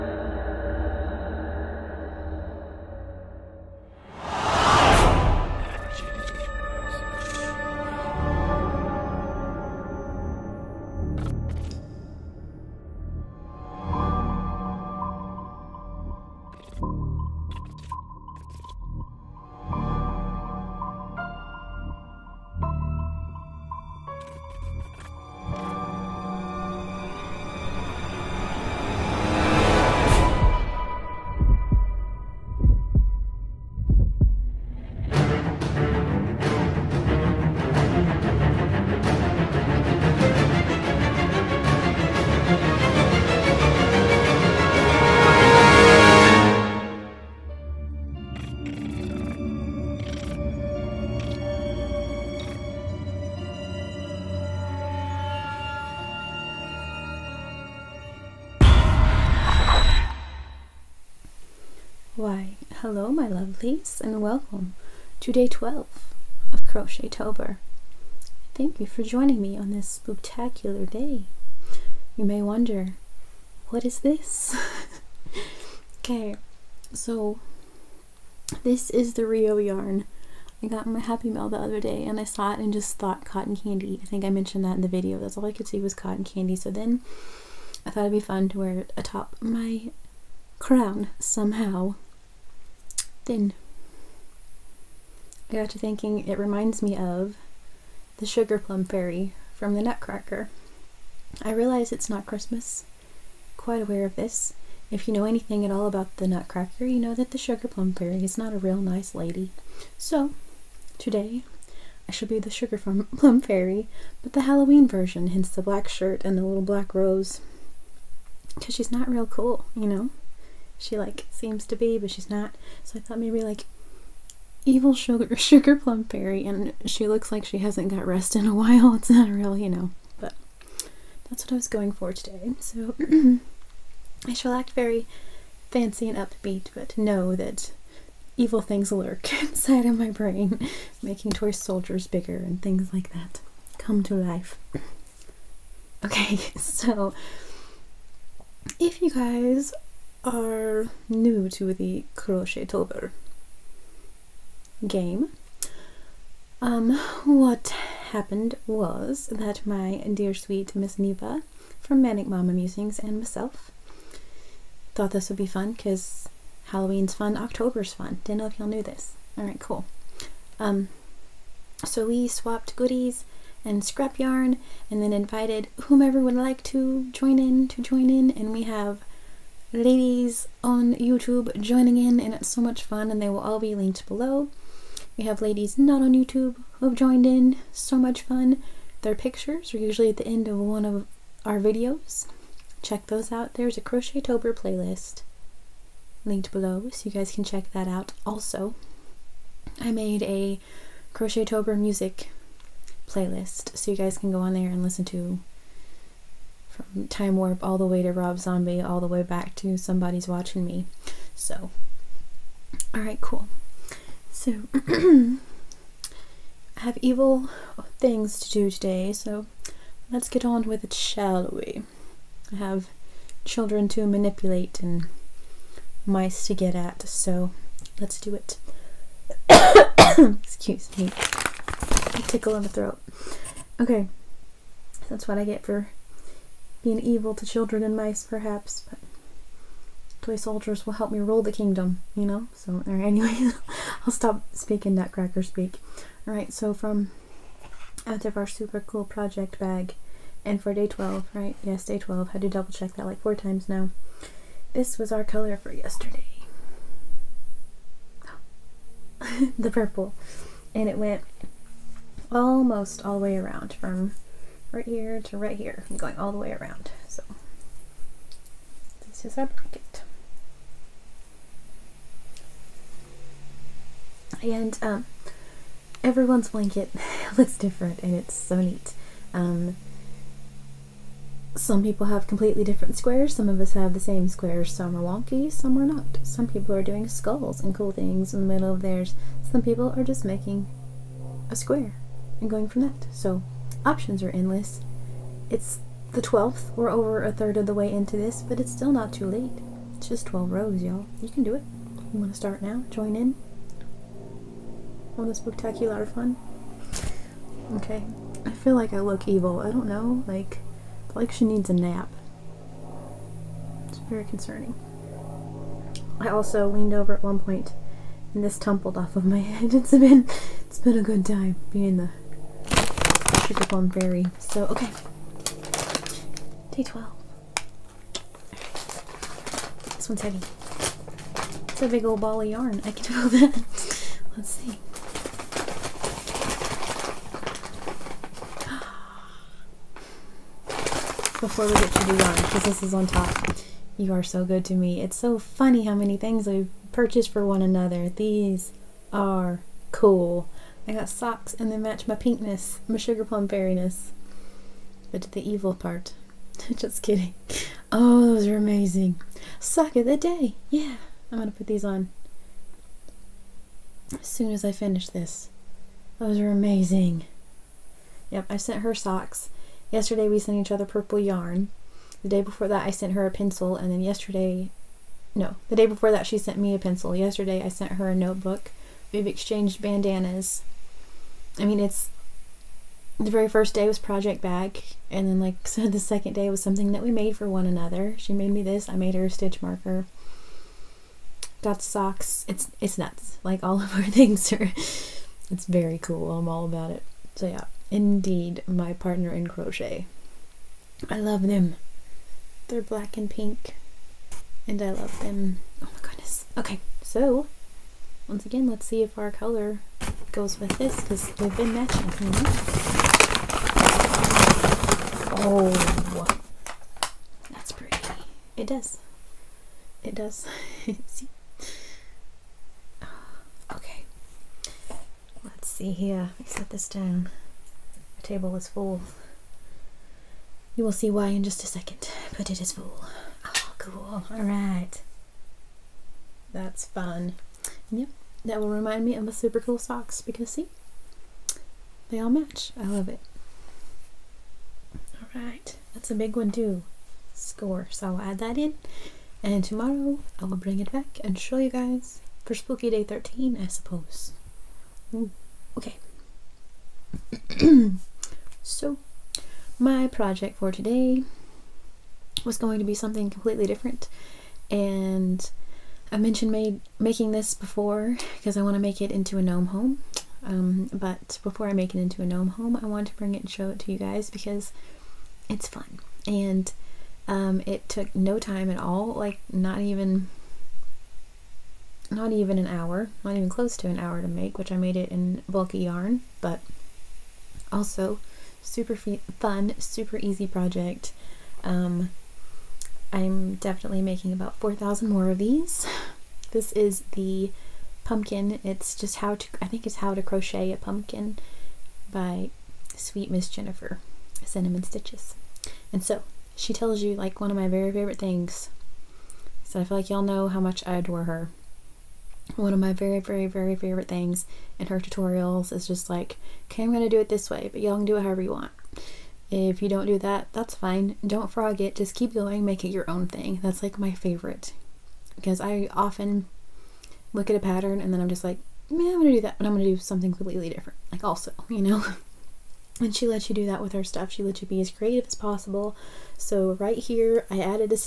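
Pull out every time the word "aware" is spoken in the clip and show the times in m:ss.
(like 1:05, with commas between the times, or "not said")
1:43.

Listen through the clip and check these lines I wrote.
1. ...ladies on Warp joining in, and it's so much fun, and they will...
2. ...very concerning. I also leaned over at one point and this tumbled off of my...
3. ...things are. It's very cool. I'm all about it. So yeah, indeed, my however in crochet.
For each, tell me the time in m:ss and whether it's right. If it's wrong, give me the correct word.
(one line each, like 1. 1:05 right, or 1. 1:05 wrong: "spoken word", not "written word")
1. 2:59 wrong: "YouTube", not "Warp"
2. 5:13 right
3. 6:34 wrong: "partner", not "however".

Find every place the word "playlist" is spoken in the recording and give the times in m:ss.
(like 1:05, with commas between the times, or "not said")
3:14, 3:23.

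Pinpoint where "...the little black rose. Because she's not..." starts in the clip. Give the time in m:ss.
1:56.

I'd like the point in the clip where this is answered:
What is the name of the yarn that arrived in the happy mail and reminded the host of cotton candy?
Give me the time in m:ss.
1:19.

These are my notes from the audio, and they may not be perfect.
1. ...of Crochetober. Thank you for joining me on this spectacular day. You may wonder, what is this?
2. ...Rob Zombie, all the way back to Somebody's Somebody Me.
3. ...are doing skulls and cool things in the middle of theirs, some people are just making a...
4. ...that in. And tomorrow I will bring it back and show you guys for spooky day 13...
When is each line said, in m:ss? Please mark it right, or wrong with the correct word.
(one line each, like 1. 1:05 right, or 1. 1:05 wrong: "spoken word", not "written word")
1. 1:06 right
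2. 3:28 wrong: "Watching", not "Somebody"
3. 4:46 right
4. 7:28 right.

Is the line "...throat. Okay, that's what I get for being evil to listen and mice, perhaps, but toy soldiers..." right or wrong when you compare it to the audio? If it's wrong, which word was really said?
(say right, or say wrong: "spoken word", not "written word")
wrong: "children", not "listen".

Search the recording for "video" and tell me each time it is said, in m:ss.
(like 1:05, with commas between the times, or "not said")
1:24, 3:11.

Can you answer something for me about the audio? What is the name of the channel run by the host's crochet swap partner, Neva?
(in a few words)
manic mama musings.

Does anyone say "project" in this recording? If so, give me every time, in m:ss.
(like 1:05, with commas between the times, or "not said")
4:09, 6:23, 7:40, 8:10.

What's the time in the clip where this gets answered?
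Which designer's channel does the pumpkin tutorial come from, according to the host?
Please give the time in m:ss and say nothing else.
8:24.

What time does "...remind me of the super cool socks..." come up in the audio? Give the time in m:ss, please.
7:18.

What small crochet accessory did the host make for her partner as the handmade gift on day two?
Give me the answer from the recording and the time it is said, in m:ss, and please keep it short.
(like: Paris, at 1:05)
stitch marker, at 6:29.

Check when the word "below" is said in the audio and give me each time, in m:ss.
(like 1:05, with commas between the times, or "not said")
3:04, 3:16.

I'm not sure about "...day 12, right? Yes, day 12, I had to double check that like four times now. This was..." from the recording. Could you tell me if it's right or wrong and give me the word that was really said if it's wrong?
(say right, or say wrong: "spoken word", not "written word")
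right.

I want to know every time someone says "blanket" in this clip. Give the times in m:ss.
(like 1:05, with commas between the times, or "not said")
4:29, 4:36.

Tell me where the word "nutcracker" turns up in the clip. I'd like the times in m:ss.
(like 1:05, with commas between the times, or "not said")
1:39, 1:46, 4:04.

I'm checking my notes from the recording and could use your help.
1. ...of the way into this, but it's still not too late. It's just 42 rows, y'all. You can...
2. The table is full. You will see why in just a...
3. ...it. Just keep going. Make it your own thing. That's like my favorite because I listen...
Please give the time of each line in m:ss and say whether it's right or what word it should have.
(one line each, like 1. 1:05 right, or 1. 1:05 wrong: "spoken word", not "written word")
1. 4:57 wrong: "12", not "42"
2. 7:08 right
3. 8:41 wrong: "often", not "listen".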